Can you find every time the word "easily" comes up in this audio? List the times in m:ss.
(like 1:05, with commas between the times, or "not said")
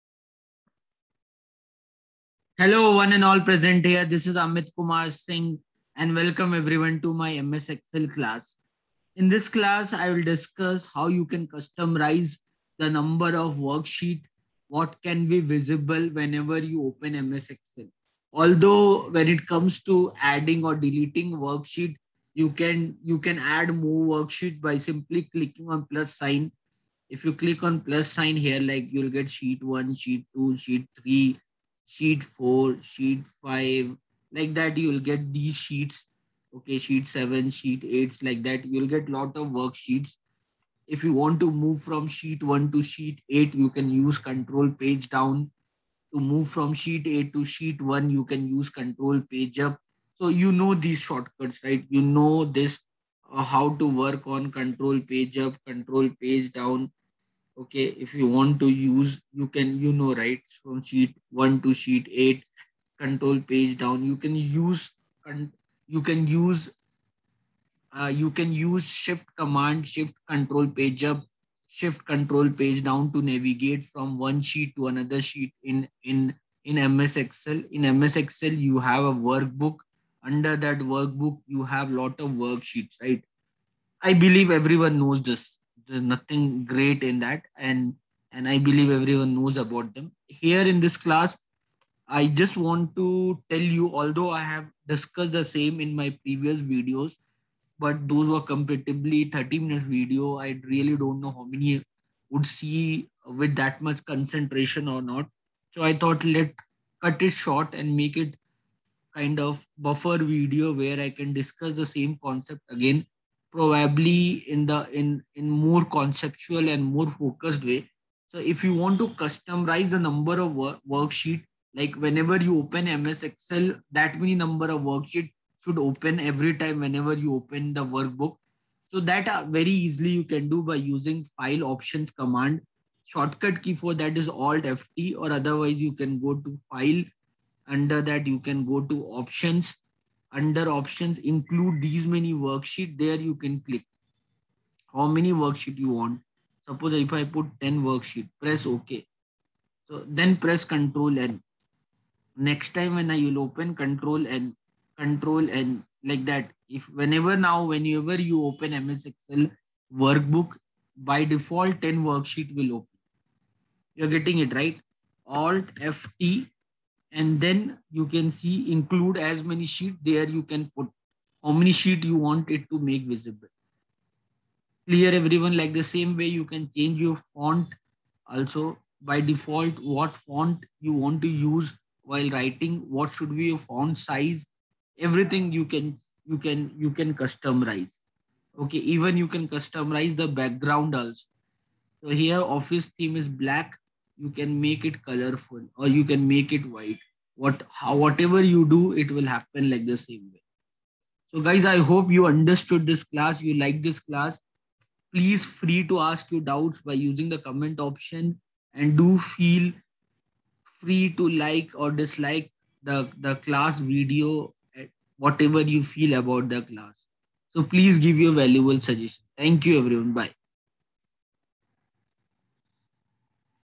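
2:09.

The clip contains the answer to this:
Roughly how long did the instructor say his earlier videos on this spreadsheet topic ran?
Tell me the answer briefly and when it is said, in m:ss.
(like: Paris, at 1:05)
30 minutes, at 1:39.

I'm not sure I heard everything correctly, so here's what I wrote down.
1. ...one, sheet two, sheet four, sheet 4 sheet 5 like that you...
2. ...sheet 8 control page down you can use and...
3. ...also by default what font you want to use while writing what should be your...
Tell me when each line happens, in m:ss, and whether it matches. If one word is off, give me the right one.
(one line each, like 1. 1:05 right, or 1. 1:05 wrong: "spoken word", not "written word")
1. 0:29 wrong: "three", not "four"
2. 1:01 right
3. 2:58 right.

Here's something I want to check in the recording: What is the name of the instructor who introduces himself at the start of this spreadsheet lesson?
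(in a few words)
Amit Kumar Singh.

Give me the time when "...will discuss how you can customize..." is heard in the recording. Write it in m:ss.
0:10.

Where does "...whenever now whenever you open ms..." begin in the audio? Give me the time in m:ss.
2:37.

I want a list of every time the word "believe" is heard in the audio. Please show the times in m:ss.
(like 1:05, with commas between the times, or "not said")
1:24, 1:28.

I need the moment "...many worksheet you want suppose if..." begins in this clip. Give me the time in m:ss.
2:25.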